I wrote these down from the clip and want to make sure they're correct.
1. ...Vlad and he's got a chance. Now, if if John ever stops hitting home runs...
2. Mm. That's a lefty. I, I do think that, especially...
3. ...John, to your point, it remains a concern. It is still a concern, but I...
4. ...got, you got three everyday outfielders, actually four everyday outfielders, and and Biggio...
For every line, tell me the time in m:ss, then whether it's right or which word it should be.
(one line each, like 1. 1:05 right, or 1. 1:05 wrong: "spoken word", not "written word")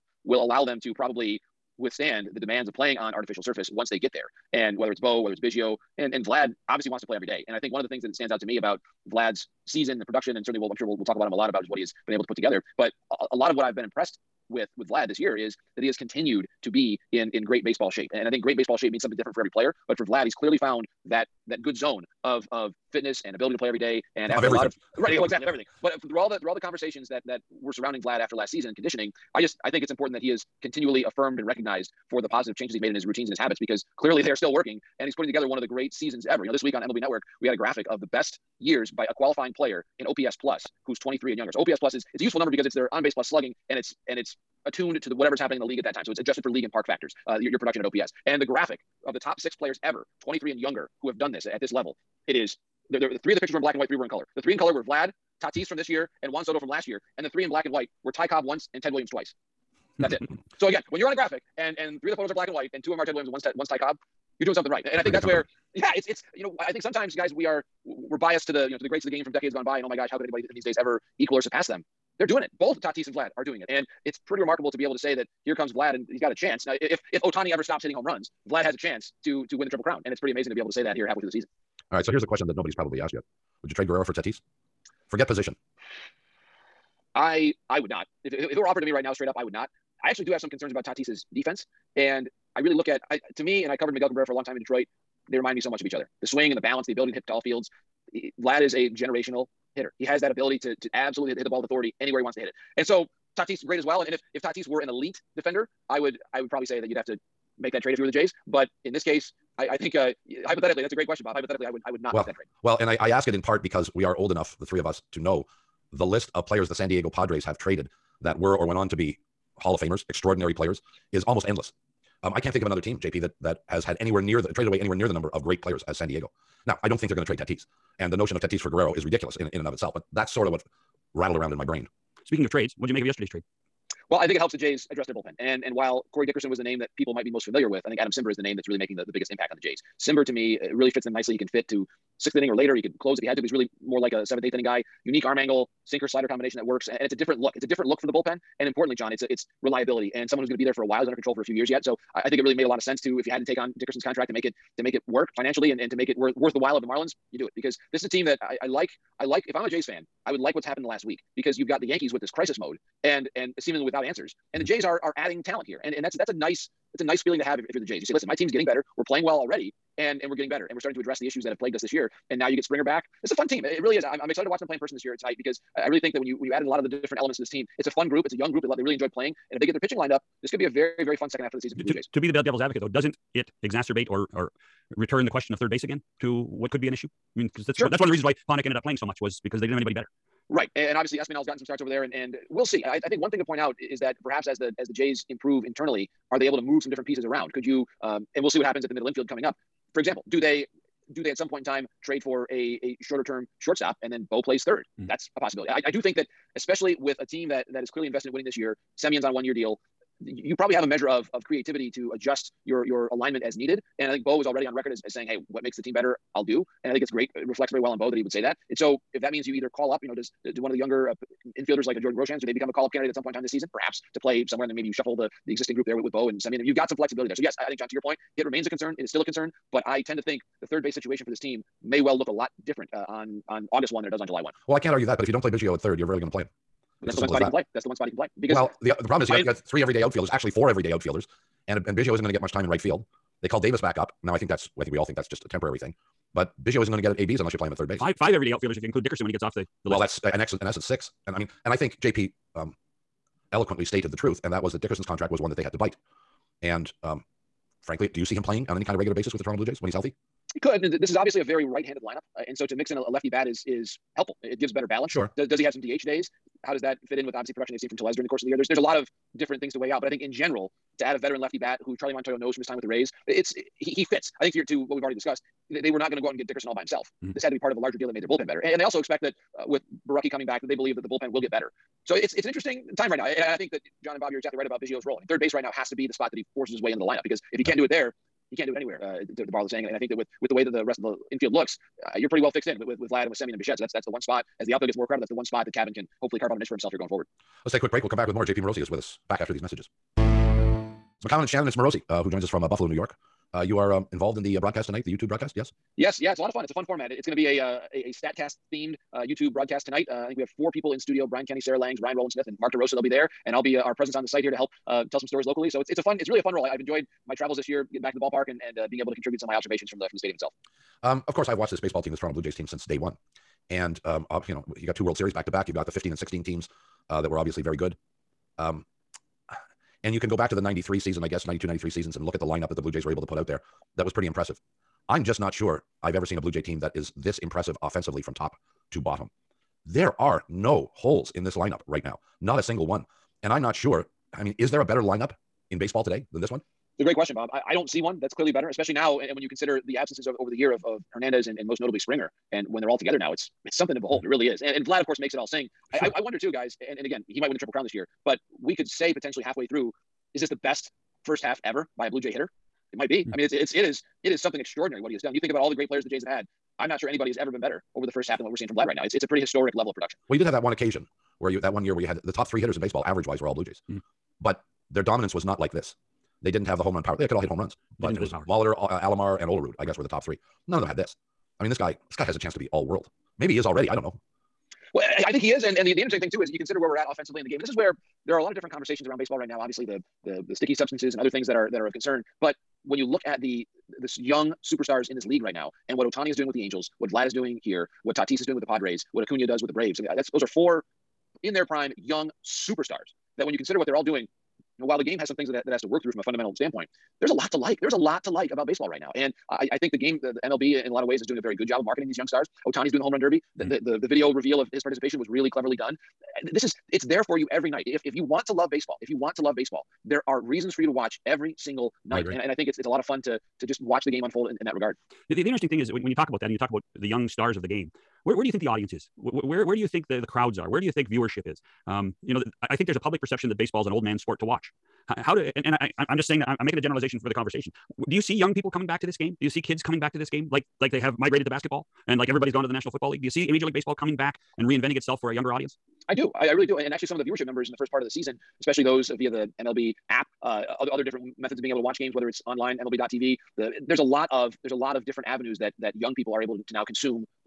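1. 1:15 wrong: "Ohtani", not "John"
2. 3:24 wrong: "possibility", not "lefty"
3. 3:47 right
4. 3:59 right.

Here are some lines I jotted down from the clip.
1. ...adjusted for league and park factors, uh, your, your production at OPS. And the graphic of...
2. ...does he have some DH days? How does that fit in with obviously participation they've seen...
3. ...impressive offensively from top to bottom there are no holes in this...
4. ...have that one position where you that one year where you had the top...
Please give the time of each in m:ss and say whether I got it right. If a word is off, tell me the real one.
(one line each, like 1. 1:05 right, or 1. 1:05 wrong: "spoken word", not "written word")
1. 0:46 right
2. 4:25 wrong: "production", not "participation"
3. 5:37 right
4. 6:10 wrong: "occasion", not "position".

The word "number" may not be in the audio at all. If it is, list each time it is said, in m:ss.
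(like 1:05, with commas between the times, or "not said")
0:42, 2:05, 7:27.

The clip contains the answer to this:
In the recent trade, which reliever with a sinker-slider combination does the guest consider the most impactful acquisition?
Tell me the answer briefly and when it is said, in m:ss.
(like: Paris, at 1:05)
Adam Cimber, at 2:17.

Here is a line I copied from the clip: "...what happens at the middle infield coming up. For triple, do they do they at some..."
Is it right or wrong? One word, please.
wrong.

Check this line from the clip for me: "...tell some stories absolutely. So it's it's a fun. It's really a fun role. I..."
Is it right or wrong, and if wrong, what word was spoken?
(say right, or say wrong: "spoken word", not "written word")
wrong: "locally", not "absolutely".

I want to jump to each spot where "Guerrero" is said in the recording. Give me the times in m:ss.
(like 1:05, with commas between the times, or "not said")
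1:23, 2:08.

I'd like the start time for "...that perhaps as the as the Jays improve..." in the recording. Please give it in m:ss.
3:14.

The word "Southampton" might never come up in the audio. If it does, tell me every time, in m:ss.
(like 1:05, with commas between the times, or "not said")
not said.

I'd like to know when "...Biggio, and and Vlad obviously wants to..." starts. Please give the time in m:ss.
0:05.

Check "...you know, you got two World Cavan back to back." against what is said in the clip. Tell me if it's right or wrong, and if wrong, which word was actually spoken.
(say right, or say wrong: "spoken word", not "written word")
wrong: "Series", not "Cavan".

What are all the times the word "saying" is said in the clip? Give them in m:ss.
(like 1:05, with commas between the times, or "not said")
3:35, 4:49, 7:16.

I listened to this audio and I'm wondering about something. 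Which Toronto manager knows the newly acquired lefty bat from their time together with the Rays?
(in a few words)
Charlie Montoyo.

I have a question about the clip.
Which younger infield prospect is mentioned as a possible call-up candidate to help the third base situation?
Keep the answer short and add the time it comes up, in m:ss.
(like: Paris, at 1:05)
Jordan Groshans, at 3:41.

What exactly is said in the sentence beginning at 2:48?
You say, listen, my team's getting better.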